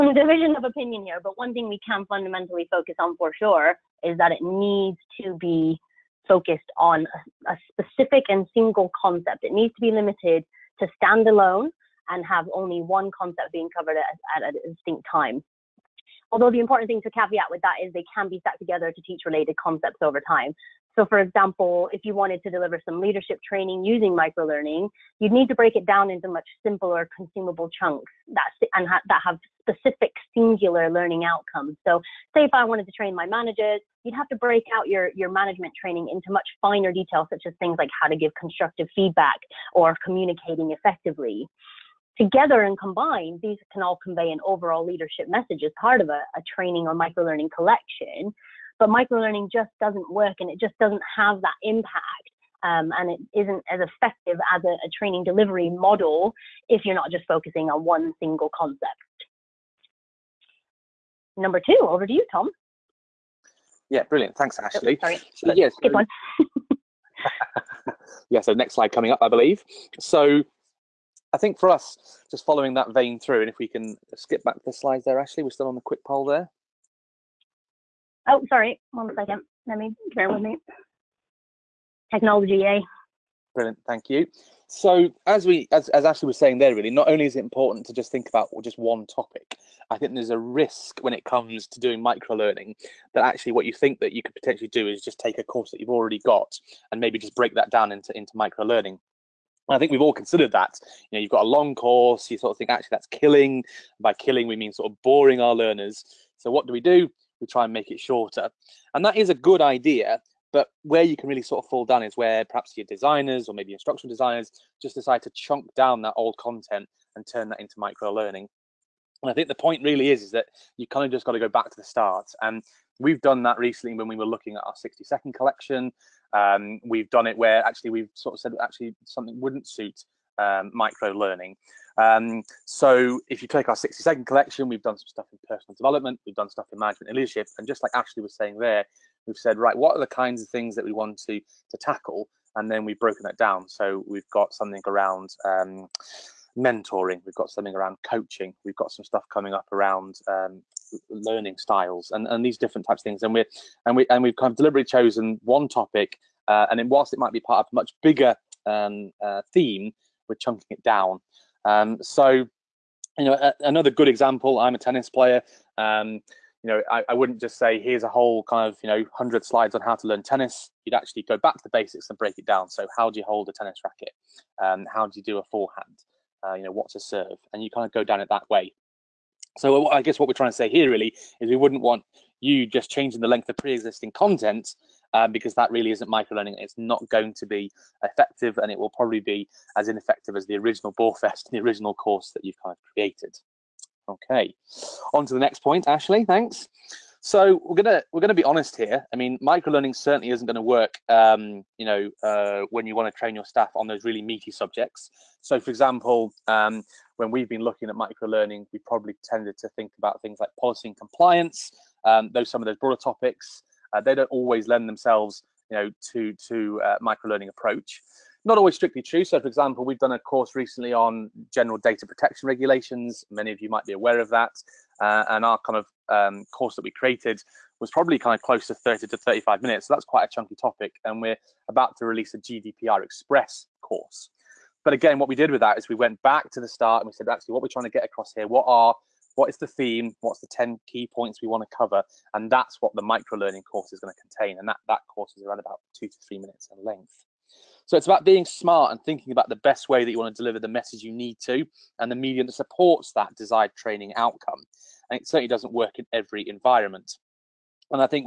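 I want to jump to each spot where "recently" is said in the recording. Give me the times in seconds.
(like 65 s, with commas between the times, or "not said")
123 s, 220 s.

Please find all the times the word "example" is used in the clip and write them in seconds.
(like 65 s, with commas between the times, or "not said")
21 s, 164 s, 205 s, 219 s.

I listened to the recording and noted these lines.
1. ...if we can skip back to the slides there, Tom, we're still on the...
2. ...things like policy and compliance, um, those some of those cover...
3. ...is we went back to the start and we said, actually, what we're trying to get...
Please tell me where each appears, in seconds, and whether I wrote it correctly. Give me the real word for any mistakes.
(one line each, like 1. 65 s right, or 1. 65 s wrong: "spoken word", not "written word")
1. 73 s wrong: "Ashley", not "Tom"
2. 210 s wrong: "broader", not "cover"
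3. 235 s right.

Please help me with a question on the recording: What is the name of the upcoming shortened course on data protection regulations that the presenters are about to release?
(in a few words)
GDPR Express.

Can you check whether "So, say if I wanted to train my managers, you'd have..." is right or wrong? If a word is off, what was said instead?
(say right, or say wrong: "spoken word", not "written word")
right.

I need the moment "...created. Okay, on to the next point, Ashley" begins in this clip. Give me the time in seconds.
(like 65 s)
192 s.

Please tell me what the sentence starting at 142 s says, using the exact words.
And then we've broken that down.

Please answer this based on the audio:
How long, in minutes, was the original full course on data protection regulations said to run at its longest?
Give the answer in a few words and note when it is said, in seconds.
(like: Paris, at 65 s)
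35 minutes, at 229 s.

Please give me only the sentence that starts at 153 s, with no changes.
And we're and we and we've kind of deliberately chosen one topic.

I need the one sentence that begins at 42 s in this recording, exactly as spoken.
Together and combined, these can all convey an overall leadership message as part of a, a training or microlearning collection.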